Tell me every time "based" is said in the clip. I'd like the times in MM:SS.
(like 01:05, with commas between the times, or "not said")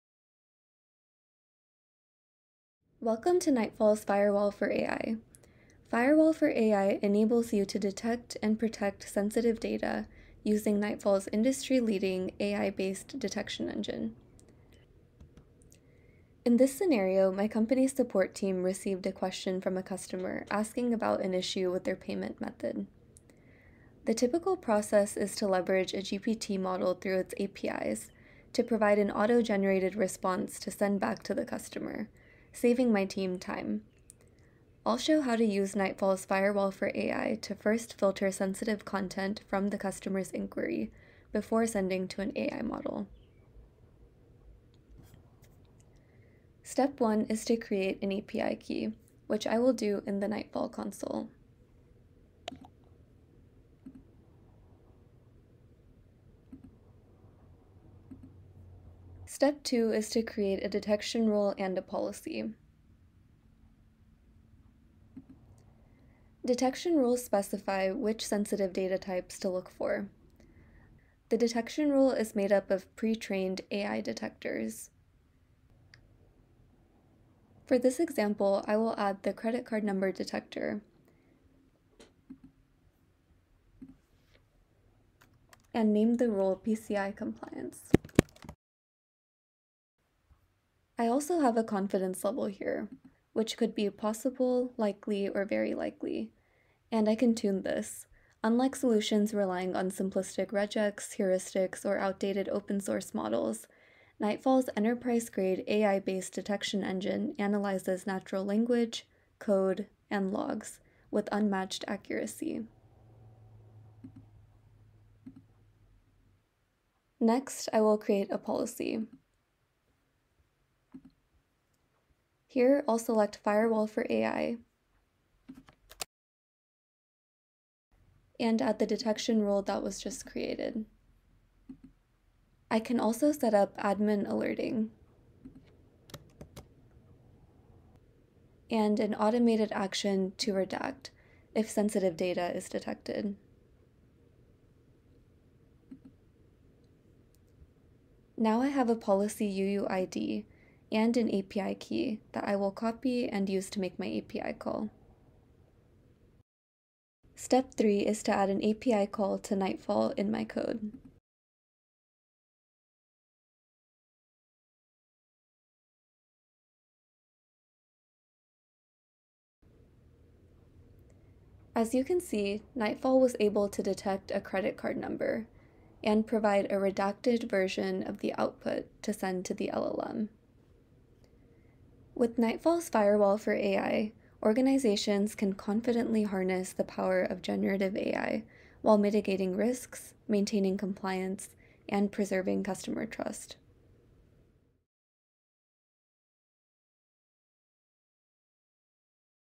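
00:12, 01:45.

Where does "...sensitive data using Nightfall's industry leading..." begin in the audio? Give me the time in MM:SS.
00:09.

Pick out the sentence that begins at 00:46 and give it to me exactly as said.
Step 1 is to create an API key, which I will do in the Nightfall console.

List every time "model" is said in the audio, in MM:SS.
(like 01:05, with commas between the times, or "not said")
00:26, 00:42, 01:43.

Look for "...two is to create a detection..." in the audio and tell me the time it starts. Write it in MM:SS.
00:59.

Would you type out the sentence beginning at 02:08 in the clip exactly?
And add the detection rule that was just created.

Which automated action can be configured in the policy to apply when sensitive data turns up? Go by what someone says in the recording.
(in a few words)
redact.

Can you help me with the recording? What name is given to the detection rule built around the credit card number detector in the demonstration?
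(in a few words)
PCI compliance.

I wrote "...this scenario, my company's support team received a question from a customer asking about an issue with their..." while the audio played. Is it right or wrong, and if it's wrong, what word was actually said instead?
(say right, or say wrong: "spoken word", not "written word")
right.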